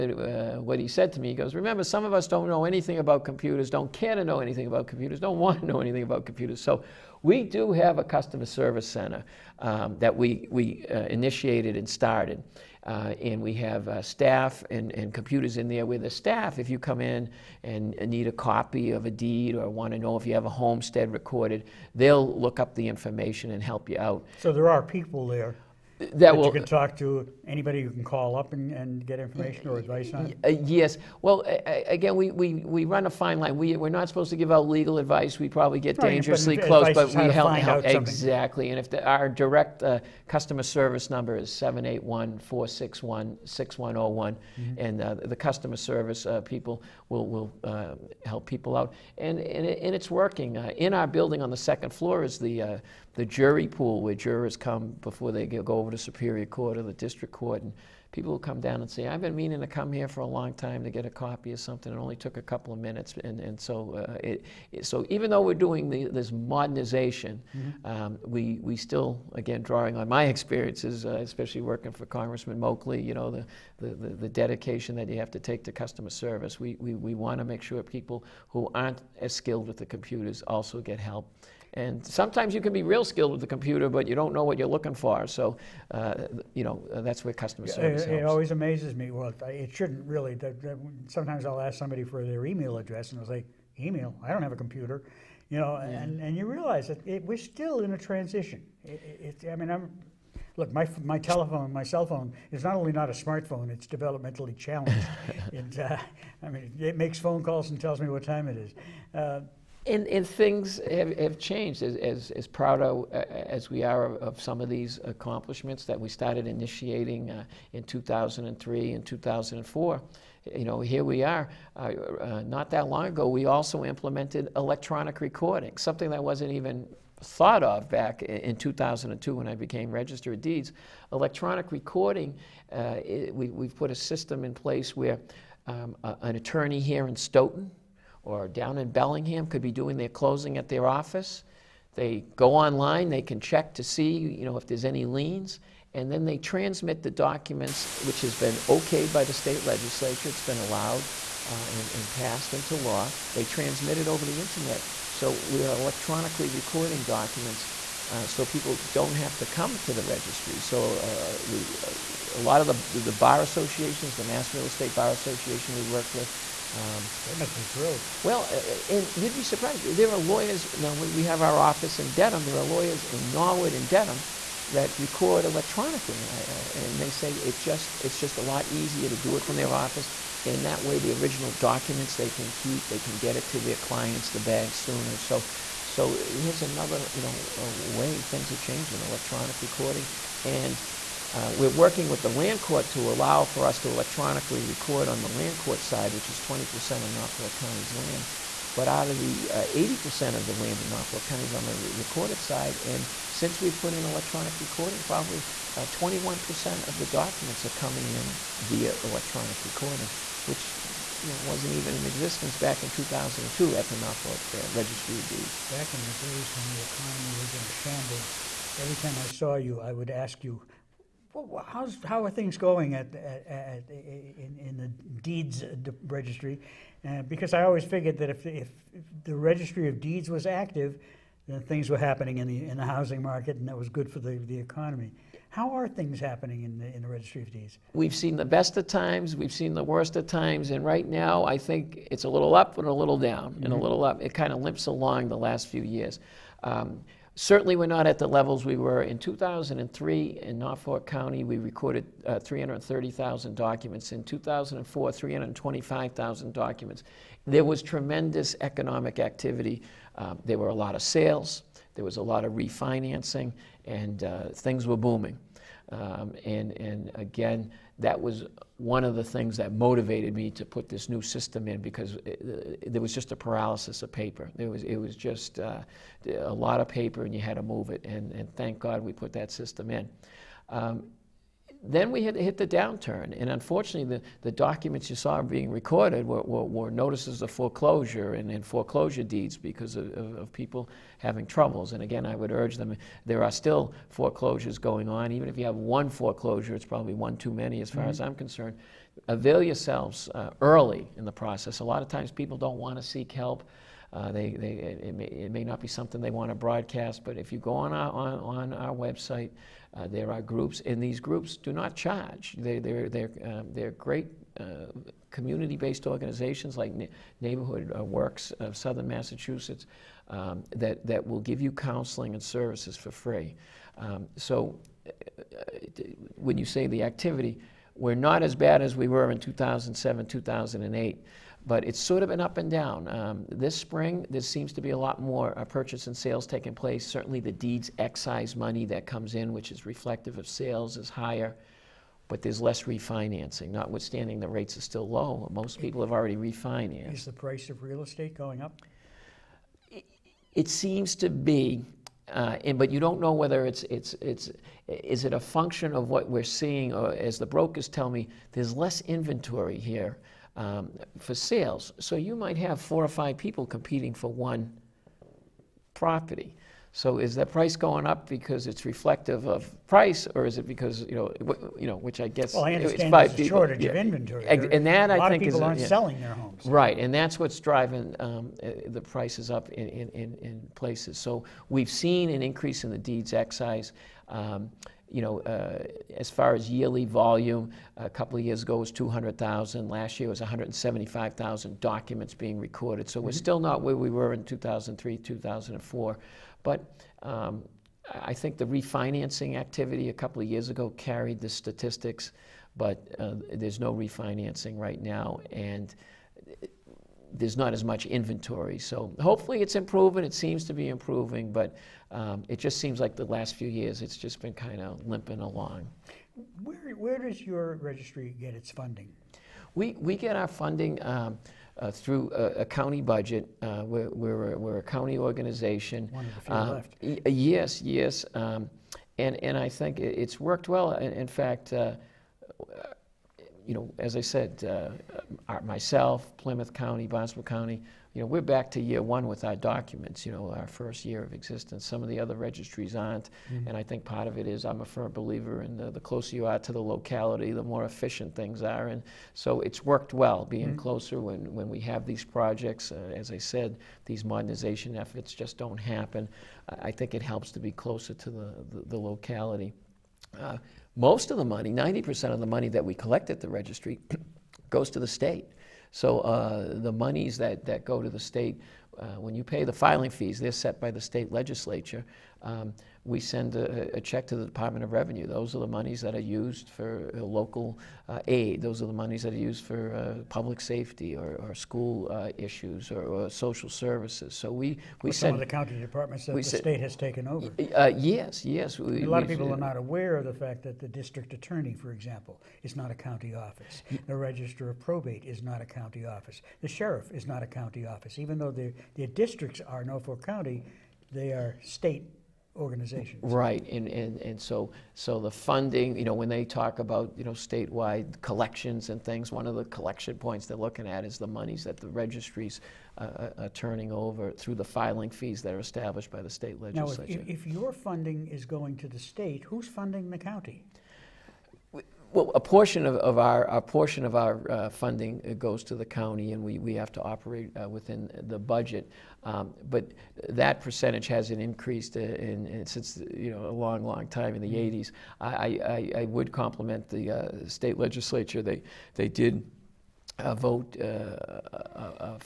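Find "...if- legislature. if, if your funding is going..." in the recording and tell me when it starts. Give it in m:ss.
8:36.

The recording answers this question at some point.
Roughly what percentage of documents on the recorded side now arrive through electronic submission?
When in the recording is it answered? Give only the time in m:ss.
3:25.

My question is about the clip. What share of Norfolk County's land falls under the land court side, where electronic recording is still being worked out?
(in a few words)
20%.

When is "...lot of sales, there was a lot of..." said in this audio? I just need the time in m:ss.
4:20.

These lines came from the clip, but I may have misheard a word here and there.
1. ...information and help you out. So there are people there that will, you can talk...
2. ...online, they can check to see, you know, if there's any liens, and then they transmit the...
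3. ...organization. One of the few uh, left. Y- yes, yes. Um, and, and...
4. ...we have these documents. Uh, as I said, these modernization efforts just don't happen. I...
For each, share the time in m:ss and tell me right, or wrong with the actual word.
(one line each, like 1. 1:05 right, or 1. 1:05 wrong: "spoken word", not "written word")
1. 0:22 right
2. 2:22 right
3. 7:05 right
4. 7:31 wrong: "projects", not "documents".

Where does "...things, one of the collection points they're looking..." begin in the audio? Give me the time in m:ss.
8:29.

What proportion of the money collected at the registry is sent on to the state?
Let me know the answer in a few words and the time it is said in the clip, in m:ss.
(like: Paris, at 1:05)
90%, at 7:41.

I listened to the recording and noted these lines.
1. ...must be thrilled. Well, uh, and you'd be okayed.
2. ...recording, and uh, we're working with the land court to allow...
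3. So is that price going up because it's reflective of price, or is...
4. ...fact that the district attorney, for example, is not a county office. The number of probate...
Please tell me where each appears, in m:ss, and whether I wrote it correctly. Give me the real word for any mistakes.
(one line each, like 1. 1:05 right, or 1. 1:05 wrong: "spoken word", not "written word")
1. 2:47 wrong: "surprised", not "okayed"
2. 3:09 right
3. 6:06 right
4. 8:10 wrong: "register", not "number".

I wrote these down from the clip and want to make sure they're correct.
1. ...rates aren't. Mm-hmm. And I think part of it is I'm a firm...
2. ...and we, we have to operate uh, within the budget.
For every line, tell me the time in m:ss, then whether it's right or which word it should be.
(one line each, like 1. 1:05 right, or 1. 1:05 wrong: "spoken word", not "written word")
1. 7:22 wrong: "registries", not "rates"
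2. 8:46 right.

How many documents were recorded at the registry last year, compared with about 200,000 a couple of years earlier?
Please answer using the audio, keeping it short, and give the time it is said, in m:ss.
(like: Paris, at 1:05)
175,000, at 6:30.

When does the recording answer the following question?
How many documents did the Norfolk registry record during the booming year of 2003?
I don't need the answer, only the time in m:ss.
4:12.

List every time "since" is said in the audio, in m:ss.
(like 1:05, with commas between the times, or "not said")
3:23, 8:52.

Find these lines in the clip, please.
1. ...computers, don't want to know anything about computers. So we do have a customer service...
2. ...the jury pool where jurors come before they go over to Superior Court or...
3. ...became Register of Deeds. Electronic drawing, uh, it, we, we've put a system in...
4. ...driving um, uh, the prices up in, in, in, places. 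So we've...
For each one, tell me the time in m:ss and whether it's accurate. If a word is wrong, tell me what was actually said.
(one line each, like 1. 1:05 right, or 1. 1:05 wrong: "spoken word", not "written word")
1. 0:04 right
2. 0:53 right
3. 2:09 wrong: "recording", not "drawing"
4. 6:17 right.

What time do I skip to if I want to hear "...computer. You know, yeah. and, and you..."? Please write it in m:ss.
1:34.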